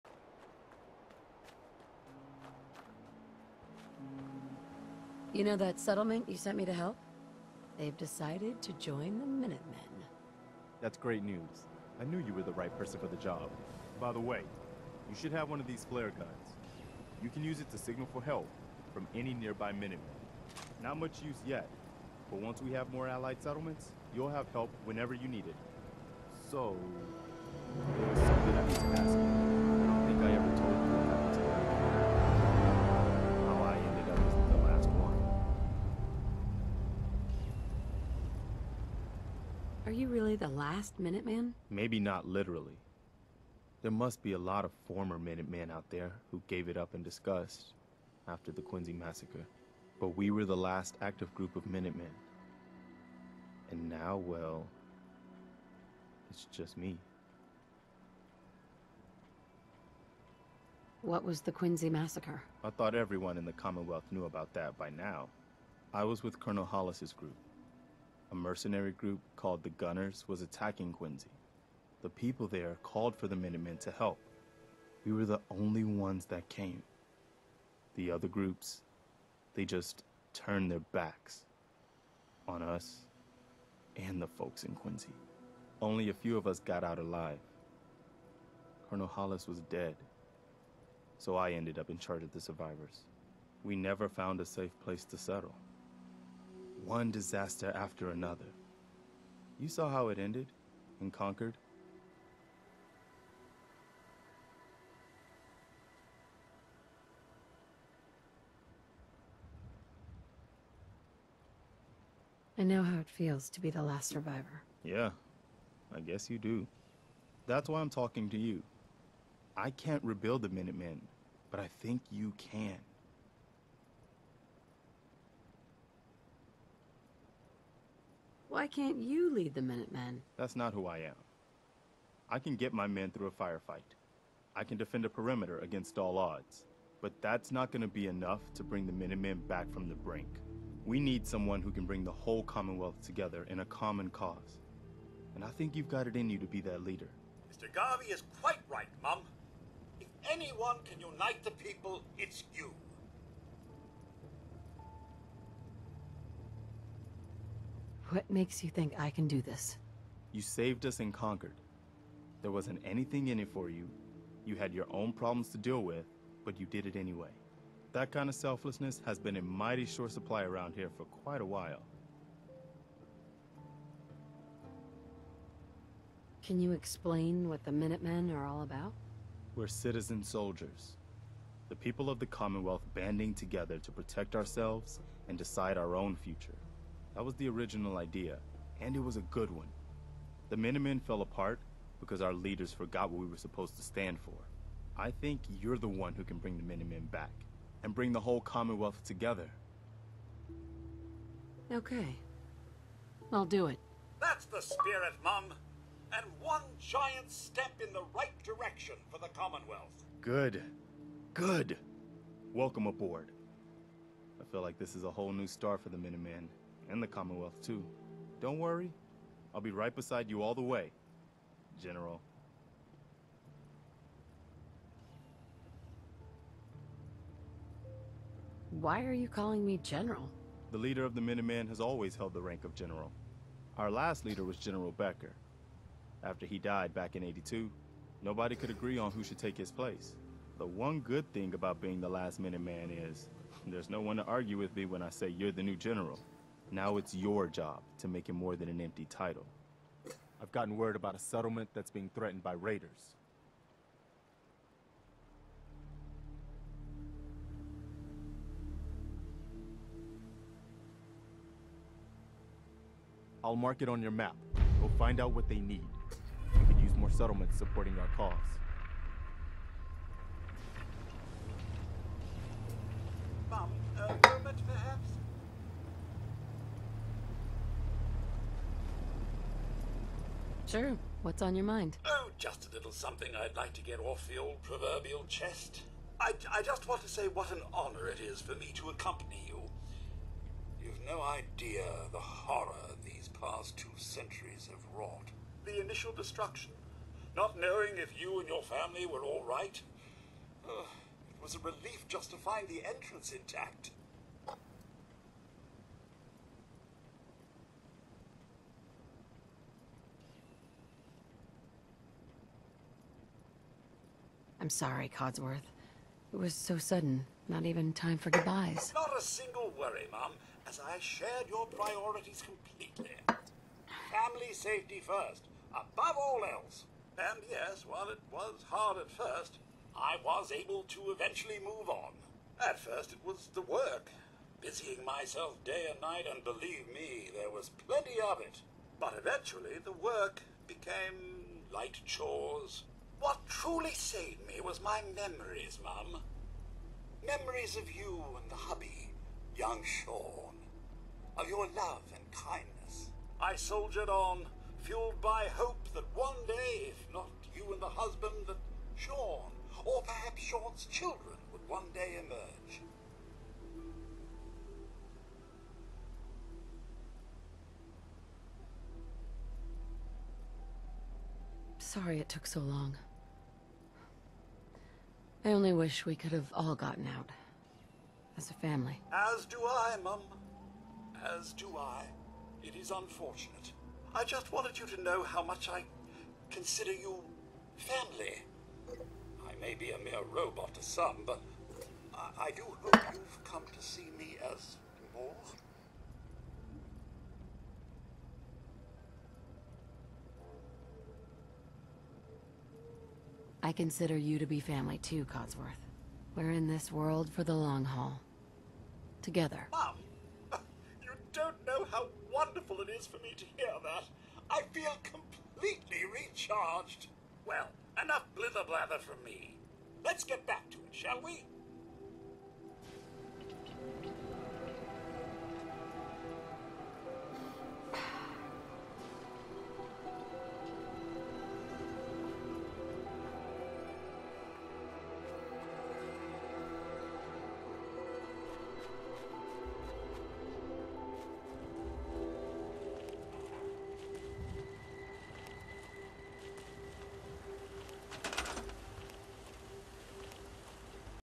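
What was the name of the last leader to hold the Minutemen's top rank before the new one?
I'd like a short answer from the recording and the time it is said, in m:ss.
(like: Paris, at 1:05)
General Becker, at 3:54.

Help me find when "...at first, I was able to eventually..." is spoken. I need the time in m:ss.
5:28.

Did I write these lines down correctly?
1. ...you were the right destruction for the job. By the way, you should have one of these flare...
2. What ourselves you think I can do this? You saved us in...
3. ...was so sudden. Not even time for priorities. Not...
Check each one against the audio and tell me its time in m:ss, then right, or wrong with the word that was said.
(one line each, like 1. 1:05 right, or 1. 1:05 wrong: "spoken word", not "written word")
1. 0:12 wrong: "person", not "destruction"
2. 2:38 wrong: "makes", not "ourselves"
3. 5:16 wrong: "goodbyes", not "priorities".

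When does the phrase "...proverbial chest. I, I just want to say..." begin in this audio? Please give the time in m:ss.
4:44.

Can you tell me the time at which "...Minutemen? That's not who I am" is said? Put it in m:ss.
2:09.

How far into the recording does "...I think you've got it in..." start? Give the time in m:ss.
2:25.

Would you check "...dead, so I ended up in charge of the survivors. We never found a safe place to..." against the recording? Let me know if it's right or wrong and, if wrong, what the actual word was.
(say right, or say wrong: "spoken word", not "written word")
right.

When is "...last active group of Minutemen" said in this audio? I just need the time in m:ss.
0:50.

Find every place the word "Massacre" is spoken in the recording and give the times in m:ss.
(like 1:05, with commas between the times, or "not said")
0:48, 1:01.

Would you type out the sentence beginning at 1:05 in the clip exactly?
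I was with Colonel Hollis's group a mercenary group called the Gunners was attacking Quincy.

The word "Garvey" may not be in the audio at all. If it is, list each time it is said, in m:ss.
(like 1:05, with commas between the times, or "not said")
2:27.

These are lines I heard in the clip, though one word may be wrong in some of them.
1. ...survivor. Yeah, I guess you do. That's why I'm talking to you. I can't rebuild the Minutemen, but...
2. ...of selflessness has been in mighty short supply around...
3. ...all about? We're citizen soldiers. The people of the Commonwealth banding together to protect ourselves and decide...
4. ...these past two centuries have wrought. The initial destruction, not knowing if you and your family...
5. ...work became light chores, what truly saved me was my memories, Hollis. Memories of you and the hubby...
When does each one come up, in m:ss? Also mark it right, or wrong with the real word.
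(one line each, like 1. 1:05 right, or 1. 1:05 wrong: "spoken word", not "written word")
1. 1:54 right
2. 2:48 right
3. 2:58 right
4. 4:53 right
5. 5:39 wrong: "Mum", not "Hollis".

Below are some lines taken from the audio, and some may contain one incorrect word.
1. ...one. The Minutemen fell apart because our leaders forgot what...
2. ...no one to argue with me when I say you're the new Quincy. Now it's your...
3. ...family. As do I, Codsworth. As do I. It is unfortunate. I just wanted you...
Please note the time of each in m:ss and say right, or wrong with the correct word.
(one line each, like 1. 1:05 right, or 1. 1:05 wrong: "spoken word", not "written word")
1. 3:09 right
2. 4:03 wrong: "General", not "Quincy"
3. 6:18 wrong: "Mum", not "Codsworth".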